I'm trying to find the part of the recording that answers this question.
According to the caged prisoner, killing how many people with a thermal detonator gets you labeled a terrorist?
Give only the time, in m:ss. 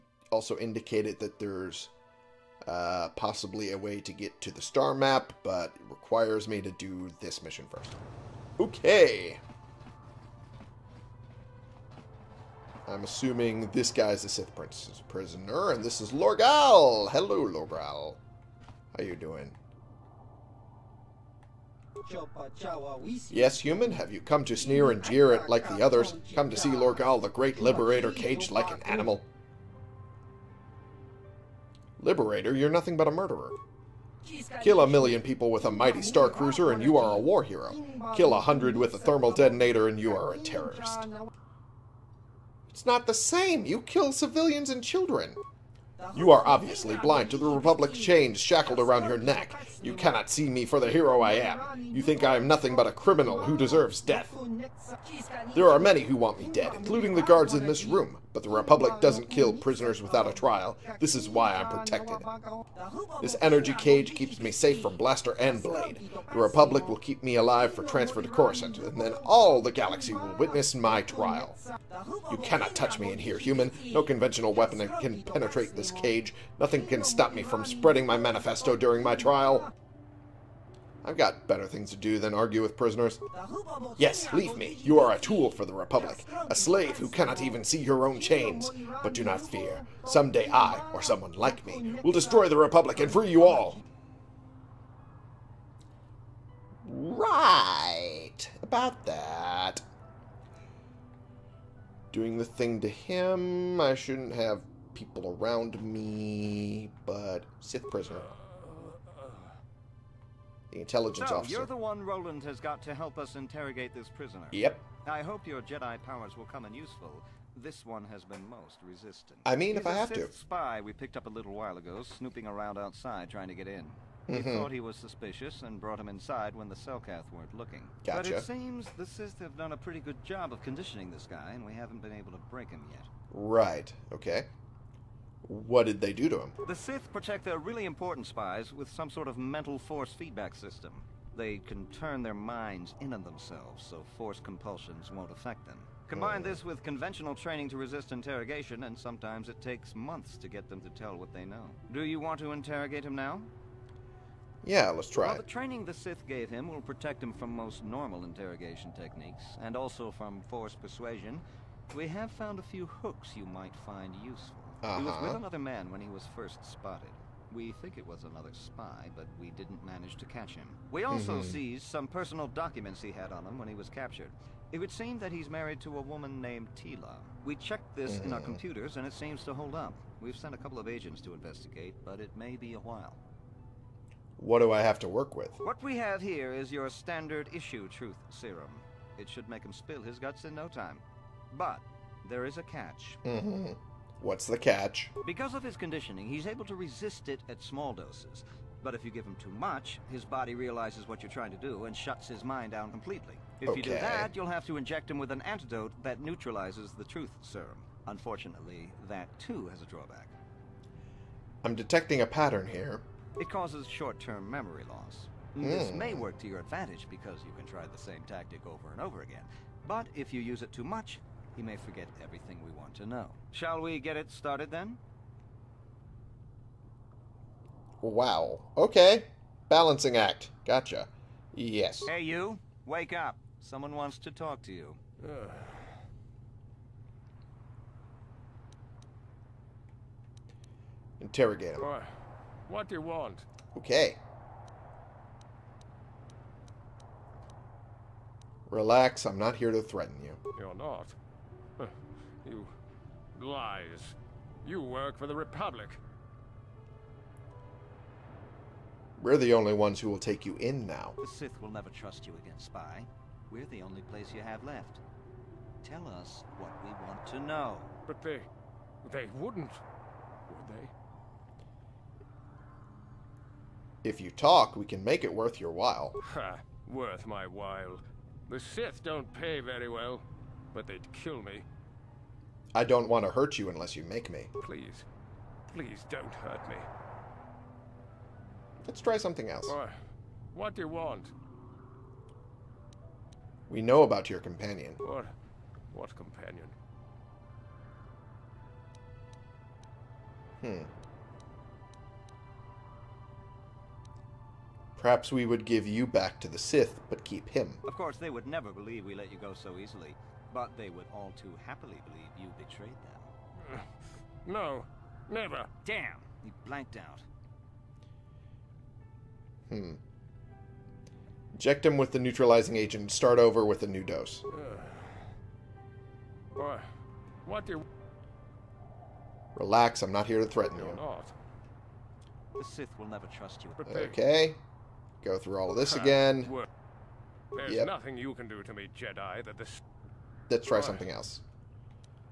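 0:38.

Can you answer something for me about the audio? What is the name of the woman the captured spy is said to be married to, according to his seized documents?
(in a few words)
Tila.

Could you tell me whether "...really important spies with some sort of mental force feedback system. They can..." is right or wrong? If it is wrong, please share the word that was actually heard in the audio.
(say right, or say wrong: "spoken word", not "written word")
right.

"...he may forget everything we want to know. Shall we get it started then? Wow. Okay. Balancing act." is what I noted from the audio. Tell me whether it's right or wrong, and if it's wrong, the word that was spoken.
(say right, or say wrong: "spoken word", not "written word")
right.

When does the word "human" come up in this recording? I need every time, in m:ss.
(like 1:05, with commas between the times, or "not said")
0:23, 1:13.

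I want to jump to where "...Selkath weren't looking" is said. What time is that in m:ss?
2:06.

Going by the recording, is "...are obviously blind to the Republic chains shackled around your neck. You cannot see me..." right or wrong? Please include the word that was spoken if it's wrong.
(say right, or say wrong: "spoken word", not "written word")
right.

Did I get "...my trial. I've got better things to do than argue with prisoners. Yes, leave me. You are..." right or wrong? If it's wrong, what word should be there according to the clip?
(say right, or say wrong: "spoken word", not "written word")
right.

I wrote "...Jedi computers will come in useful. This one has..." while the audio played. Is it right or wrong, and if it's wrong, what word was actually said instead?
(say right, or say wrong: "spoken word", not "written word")
wrong: "powers", not "computers".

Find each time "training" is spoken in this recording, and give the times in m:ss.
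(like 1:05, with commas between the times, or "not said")
2:27, 2:35.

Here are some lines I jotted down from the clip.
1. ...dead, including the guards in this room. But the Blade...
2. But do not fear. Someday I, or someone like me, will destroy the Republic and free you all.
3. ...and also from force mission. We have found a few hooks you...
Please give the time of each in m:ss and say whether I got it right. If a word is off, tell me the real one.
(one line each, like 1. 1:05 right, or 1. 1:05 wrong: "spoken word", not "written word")
1. 0:56 wrong: "Republic", not "Blade"
2. 1:29 right
3. 2:39 wrong: "persuasion", not "mission".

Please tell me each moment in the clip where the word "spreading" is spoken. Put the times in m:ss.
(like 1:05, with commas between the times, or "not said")
1:17.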